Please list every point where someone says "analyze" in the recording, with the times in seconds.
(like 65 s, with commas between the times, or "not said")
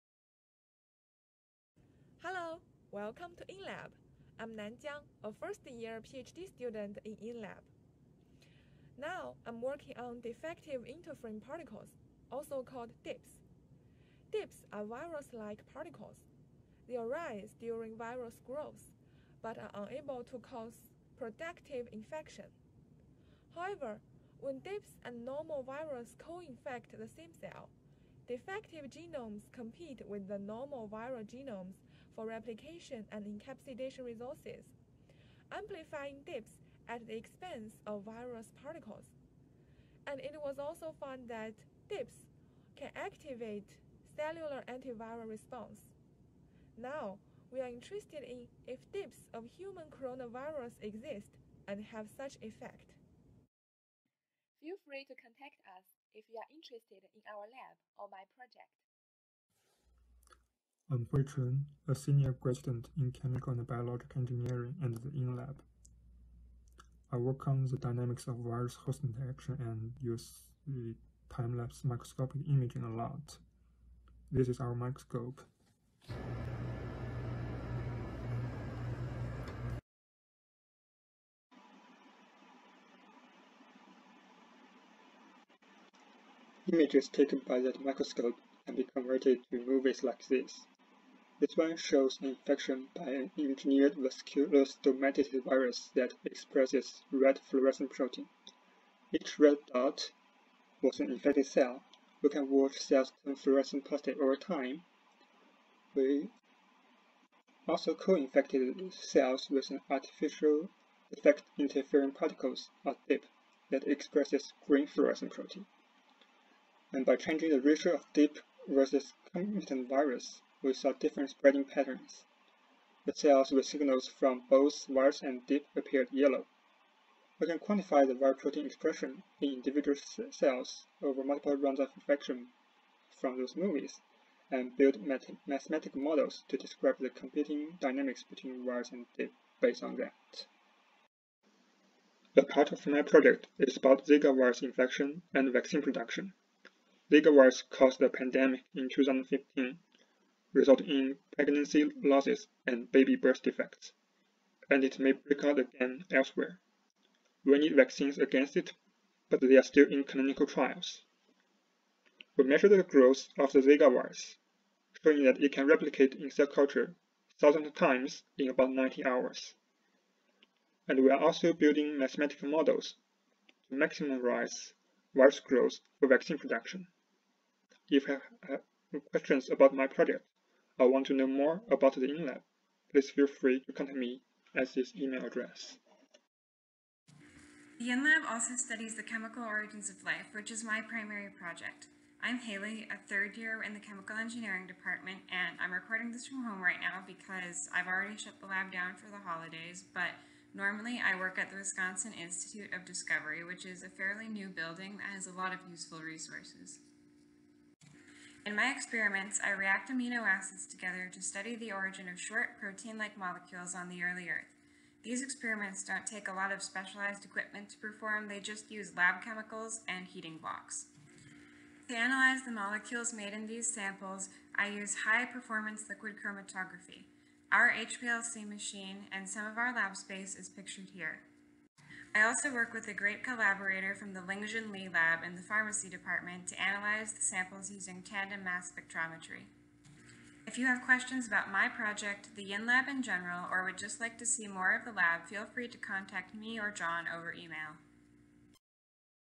221 s, 236 s.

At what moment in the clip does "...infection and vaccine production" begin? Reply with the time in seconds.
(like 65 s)
144 s.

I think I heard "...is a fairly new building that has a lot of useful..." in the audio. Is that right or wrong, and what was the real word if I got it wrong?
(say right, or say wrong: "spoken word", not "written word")
right.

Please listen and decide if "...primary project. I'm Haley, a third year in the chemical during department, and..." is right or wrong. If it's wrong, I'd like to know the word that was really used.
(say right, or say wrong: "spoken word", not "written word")
wrong: "engineering", not "during".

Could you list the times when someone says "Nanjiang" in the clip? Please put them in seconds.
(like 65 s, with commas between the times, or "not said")
4 s.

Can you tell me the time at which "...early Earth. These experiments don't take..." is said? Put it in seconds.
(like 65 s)
214 s.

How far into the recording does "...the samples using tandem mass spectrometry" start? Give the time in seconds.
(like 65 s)
237 s.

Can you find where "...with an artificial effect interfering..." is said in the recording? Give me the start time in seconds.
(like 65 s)
109 s.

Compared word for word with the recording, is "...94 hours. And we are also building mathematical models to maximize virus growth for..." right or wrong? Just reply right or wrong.
wrong.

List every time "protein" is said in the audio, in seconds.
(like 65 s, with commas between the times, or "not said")
97 s, 115 s, 128 s, 212 s.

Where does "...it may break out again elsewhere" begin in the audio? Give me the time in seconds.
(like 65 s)
154 s.